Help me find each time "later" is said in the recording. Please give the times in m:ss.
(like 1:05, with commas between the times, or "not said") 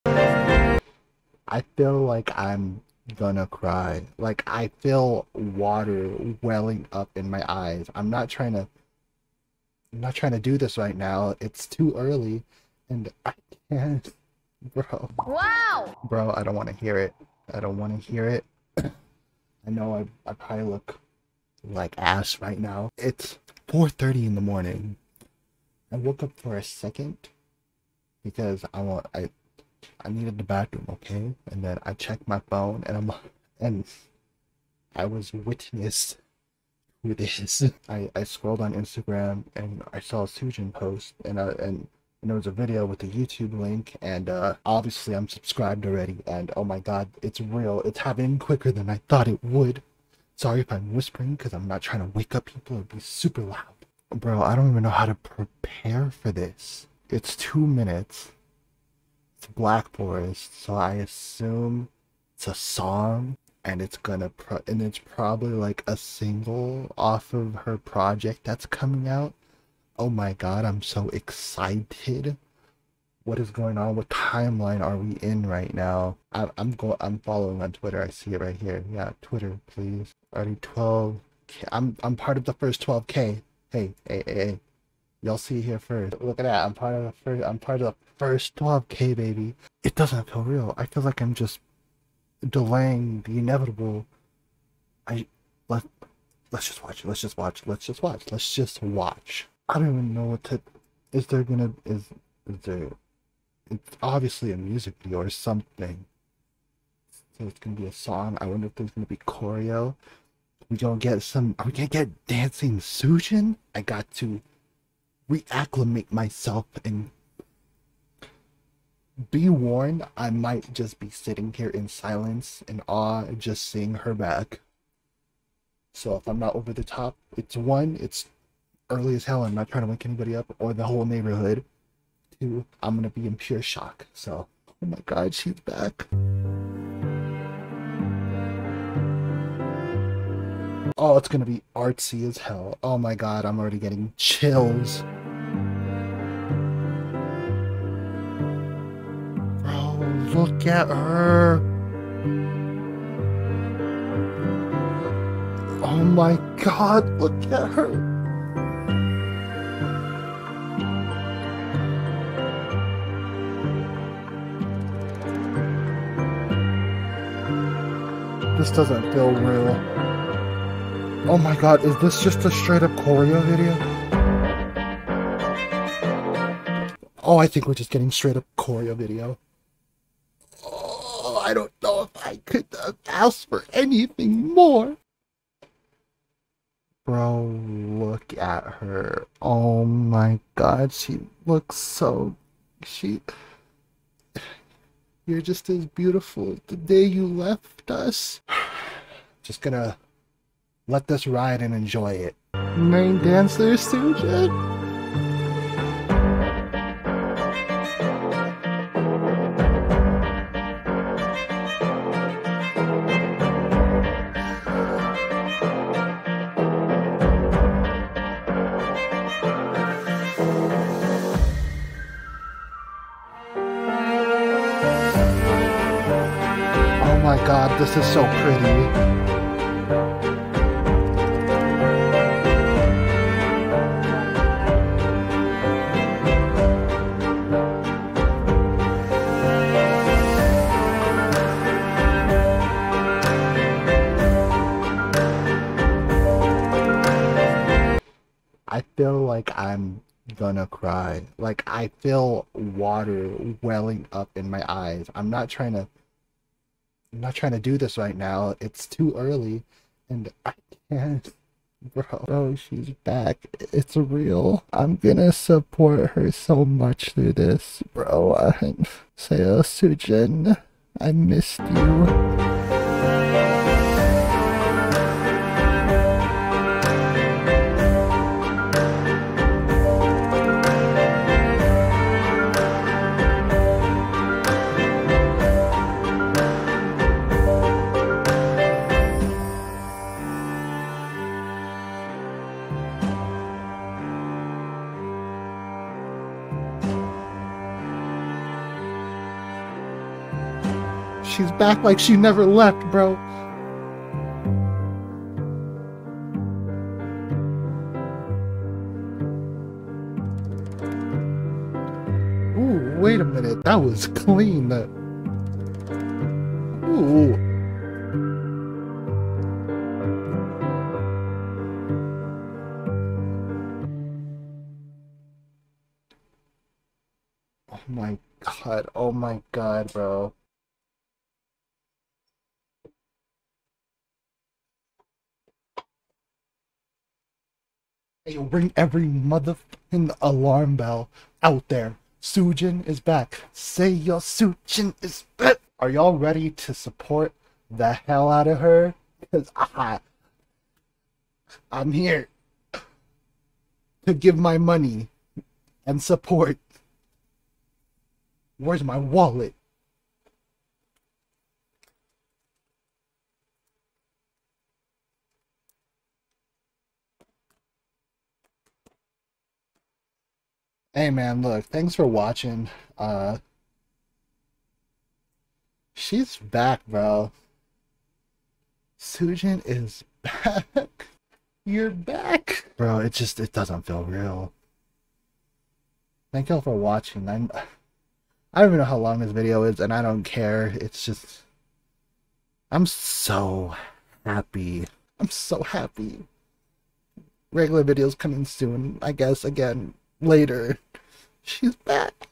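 6:40.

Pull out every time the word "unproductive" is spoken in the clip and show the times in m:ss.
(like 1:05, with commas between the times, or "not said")
not said.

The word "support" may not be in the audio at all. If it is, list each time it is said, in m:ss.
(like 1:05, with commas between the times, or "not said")
4:25, 5:46, 5:56.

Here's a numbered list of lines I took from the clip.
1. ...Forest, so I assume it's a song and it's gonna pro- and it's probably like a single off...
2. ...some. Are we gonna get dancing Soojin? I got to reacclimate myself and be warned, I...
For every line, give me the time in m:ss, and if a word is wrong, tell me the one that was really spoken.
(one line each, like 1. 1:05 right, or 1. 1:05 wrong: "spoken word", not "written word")
1. 0:59 right
2. 1:51 right.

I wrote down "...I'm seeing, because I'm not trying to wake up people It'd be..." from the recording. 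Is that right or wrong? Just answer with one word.
wrong.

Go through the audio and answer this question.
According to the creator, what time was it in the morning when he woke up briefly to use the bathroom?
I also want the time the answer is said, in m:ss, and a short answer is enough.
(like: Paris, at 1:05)
4:30, at 0:23.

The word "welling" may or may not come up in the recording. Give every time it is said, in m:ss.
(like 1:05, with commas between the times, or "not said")
0:06, 4:13.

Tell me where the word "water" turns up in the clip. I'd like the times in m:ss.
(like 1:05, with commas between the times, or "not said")
0:05, 4:12.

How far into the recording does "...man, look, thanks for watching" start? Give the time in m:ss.
6:11.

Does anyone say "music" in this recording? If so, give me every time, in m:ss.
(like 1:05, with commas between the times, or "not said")
1:44.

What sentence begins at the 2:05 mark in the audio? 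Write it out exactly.
So if I'm not over the top, it's one, it's early as hell.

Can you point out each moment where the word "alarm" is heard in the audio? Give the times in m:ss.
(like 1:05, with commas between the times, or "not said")
5:40.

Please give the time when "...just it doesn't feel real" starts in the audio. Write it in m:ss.
6:23.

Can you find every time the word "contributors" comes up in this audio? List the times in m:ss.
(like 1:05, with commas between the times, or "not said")
not said.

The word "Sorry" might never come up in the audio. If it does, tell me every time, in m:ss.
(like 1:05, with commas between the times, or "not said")
0:50.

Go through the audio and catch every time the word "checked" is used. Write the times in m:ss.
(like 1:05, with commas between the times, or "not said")
0:31.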